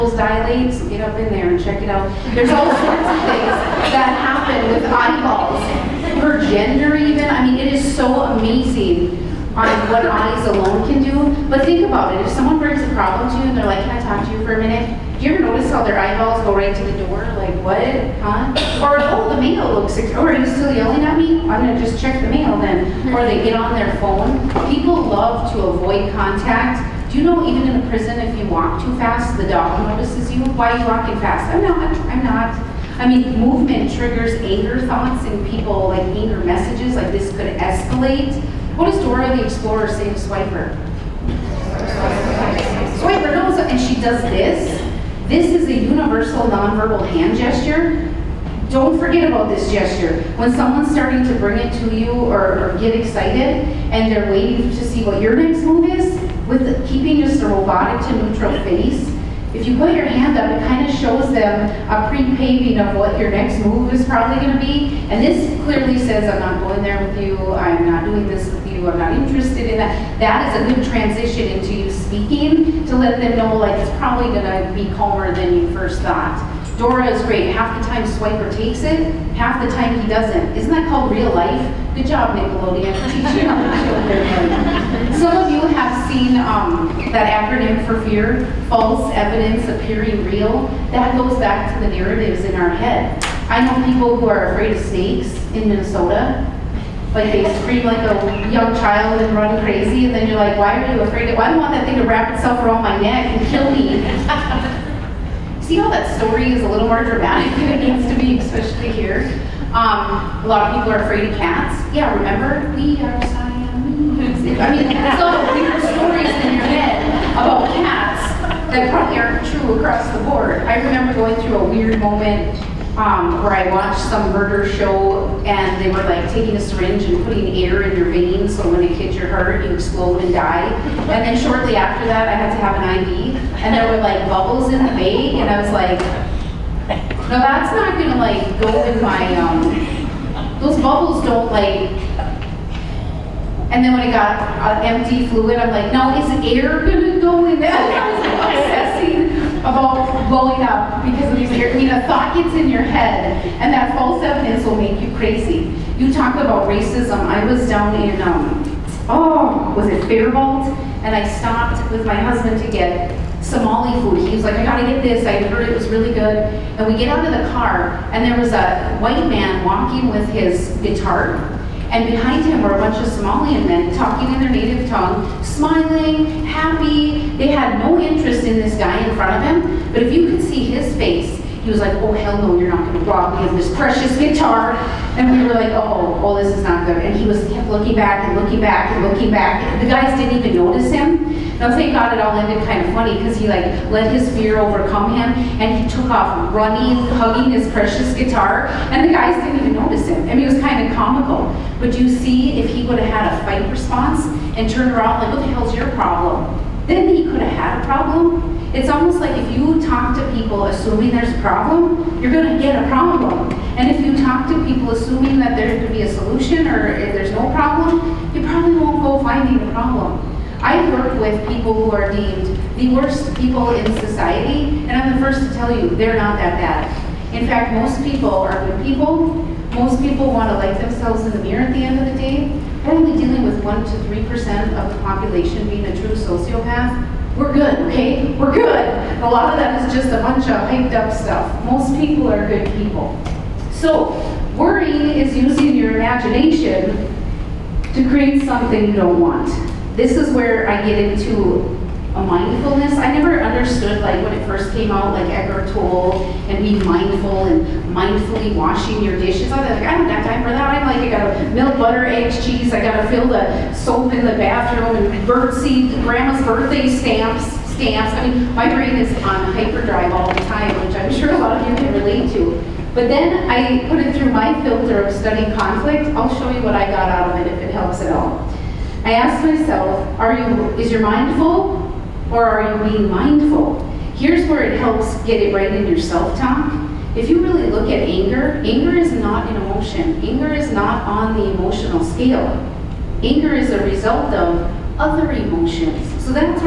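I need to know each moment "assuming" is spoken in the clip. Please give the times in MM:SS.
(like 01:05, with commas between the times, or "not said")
03:30, 03:34.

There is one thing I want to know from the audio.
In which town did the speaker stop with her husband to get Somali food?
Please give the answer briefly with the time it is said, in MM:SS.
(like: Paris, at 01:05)
Fairmont, at 02:40.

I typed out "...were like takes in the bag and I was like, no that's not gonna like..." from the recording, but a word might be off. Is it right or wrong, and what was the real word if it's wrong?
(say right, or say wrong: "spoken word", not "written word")
wrong: "bubbles", not "takes".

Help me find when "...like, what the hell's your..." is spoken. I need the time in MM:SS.
03:25.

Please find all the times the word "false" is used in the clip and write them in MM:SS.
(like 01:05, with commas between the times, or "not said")
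01:28, 02:33.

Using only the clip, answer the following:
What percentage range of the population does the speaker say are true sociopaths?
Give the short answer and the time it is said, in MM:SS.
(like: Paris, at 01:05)
1 to 3%, at 03:53.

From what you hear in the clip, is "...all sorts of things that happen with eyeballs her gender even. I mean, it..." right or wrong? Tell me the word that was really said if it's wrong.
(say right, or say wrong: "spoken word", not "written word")
right.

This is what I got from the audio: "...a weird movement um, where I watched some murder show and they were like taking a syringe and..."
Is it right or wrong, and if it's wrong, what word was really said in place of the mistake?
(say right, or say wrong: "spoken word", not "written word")
wrong: "moment", not "movement".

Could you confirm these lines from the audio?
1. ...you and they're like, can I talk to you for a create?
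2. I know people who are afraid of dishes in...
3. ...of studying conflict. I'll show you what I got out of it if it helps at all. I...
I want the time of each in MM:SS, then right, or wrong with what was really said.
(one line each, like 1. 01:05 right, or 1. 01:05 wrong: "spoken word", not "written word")
1. 00:13 wrong: "minute", not "create"
2. 01:33 wrong: "snakes", not "dishes"
3. 04:35 right.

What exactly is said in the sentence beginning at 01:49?
Um, a lot of people are afraid of cats.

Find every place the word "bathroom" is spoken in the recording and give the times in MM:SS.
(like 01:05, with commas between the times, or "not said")
04:24.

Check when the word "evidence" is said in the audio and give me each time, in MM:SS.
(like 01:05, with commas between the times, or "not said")
01:29, 02:34.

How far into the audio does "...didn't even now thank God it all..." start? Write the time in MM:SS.
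03:10.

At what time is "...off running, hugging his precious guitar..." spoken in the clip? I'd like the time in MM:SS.
03:16.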